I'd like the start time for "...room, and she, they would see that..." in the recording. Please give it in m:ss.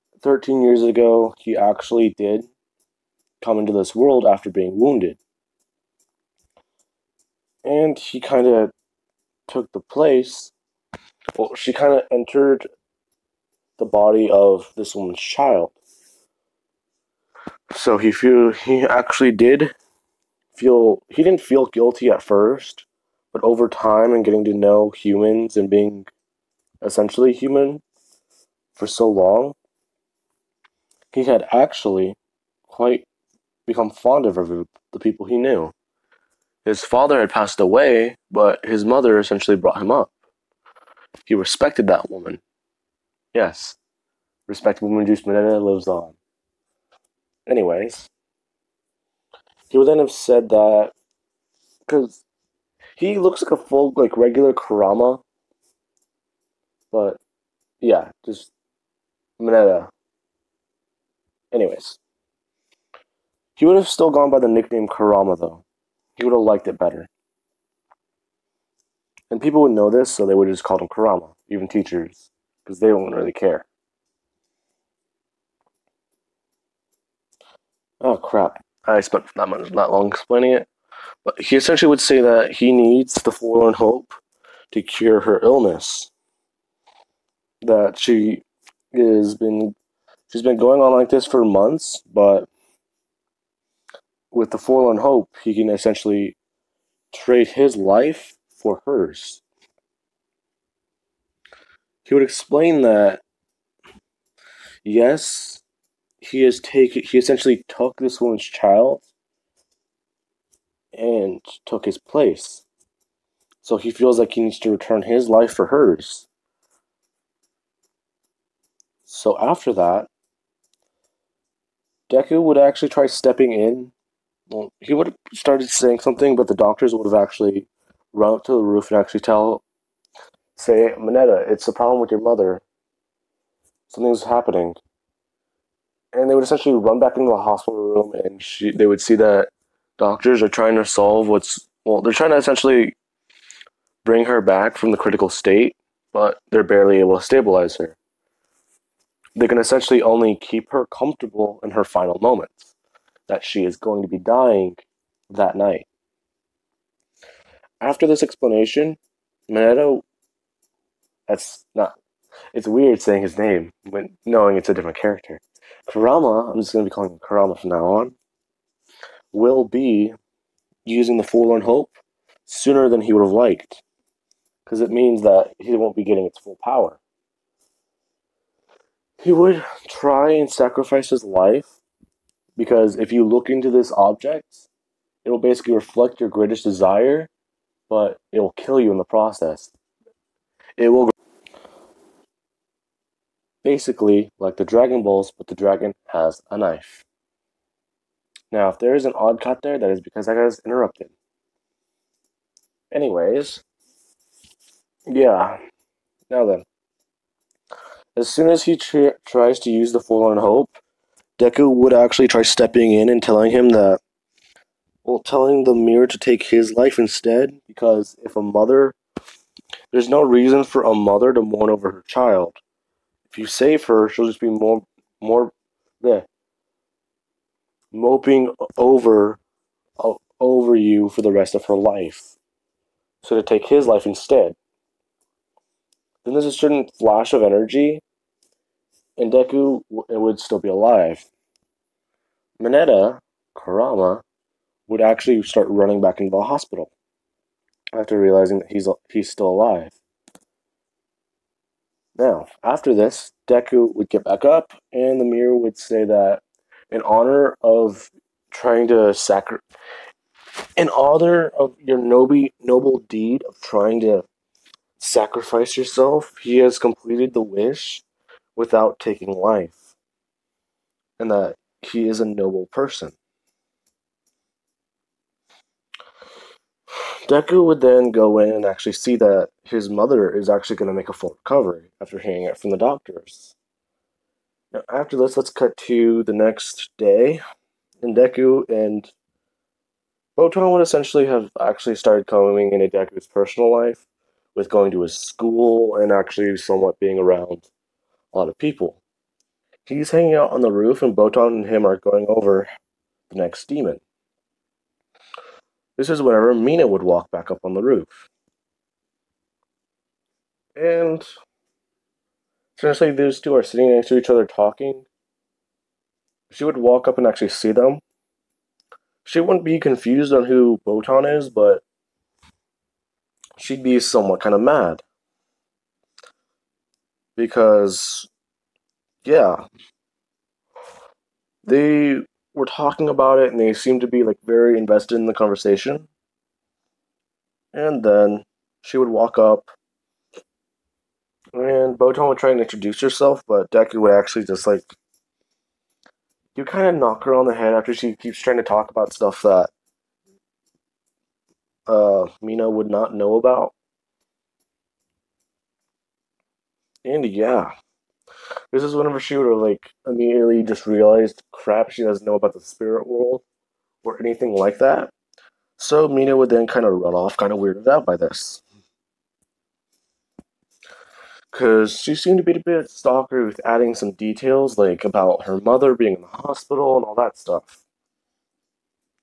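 2:17.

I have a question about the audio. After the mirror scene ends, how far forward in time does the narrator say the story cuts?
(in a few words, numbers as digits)
the next day.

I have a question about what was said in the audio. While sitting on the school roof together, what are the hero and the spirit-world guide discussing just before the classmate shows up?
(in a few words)
the next demon.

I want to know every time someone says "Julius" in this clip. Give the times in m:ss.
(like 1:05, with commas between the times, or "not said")
not said.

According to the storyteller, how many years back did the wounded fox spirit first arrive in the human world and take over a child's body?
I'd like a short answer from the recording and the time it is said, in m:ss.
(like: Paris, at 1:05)
13, at 0:00.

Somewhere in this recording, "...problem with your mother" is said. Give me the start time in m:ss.
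2:11.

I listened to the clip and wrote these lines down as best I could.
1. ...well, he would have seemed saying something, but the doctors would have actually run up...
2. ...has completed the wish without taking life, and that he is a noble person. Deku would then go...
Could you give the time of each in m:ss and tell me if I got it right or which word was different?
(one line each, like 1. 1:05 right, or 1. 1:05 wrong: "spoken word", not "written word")
1. 2:04 wrong: "started", not "seemed"
2. 4:26 right.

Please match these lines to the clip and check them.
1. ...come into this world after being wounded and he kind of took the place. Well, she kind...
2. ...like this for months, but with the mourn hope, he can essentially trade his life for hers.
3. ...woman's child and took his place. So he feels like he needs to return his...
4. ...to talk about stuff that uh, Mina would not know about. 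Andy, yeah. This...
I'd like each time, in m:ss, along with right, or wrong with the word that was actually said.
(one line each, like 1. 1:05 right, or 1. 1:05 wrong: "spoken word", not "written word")
1. 0:03 right
2. 1:30 wrong: "forlorn", not "mourn"
3. 1:48 right
4. 5:48 right.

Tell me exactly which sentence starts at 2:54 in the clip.
Because it means that he won't be getting its full power.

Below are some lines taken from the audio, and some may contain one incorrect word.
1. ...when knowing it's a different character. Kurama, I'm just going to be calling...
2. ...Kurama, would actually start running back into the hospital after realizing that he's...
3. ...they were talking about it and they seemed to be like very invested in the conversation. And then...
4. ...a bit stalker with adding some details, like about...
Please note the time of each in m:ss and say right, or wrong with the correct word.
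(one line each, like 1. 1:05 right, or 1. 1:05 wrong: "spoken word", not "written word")
1. 2:43 right
2. 4:03 right
3. 5:31 right
4. 6:12 right.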